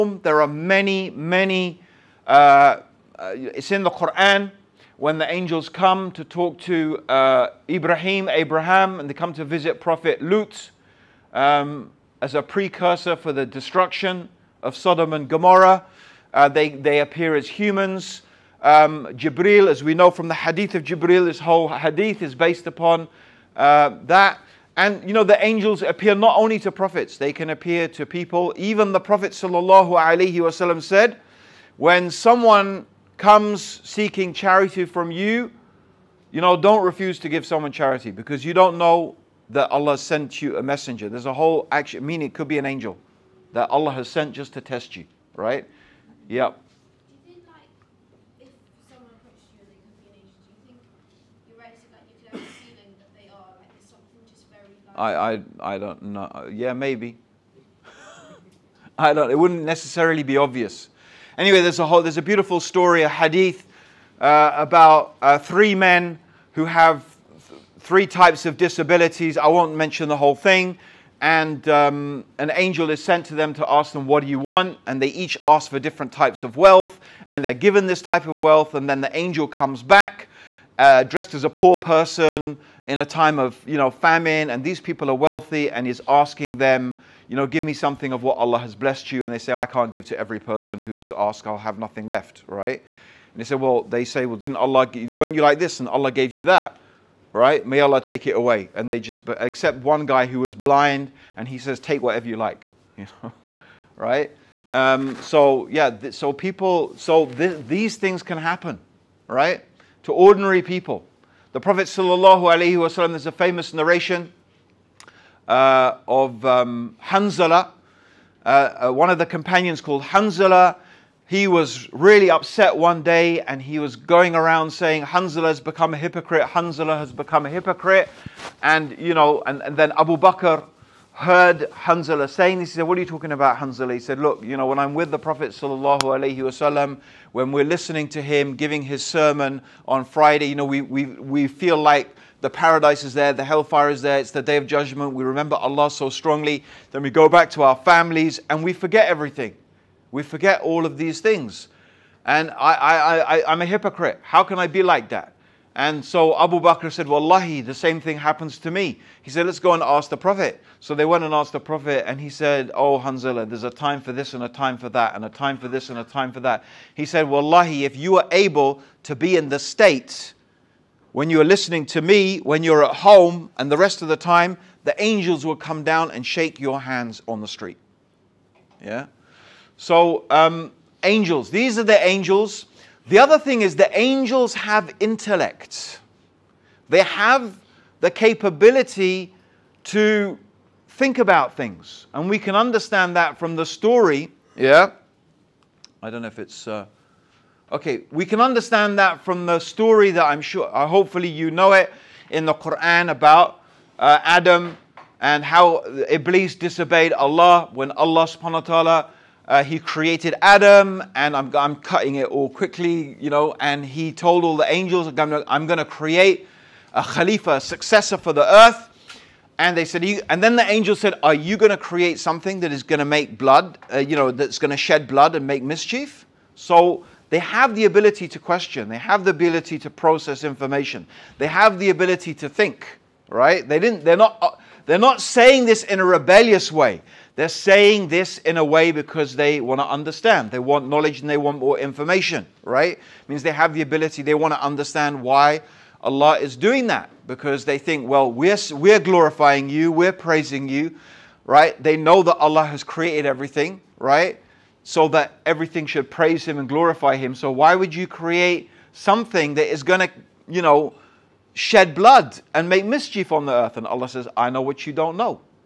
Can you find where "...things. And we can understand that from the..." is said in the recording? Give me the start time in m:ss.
3:11.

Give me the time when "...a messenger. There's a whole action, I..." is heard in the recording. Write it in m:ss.
0:40.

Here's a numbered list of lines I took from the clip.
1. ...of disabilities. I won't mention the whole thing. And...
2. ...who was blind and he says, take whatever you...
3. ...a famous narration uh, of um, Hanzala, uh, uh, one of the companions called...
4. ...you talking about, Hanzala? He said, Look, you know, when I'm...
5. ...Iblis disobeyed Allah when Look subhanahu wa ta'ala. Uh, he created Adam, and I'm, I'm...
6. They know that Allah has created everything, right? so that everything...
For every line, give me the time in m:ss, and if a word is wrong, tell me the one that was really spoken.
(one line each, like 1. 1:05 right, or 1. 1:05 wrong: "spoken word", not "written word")
1. 1:08 right
2. 1:40 right
3. 1:53 right
4. 2:13 right
5. 3:26 wrong: "Allah", not "Look"
6. 4:11 right.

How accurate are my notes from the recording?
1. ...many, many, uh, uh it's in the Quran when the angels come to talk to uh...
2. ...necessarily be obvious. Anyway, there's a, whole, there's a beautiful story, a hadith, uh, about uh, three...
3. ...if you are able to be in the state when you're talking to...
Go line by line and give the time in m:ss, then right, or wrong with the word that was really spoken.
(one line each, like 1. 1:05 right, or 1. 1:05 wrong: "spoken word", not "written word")
1. 0:00 right
2. 0:59 right
3. 2:47 wrong: "listening", not "talking".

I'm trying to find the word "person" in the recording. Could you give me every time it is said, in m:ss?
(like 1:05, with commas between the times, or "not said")
1:21, 1:30.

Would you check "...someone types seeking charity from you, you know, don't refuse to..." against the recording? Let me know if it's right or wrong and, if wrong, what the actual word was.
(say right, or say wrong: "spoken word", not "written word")
wrong: "comes", not "types".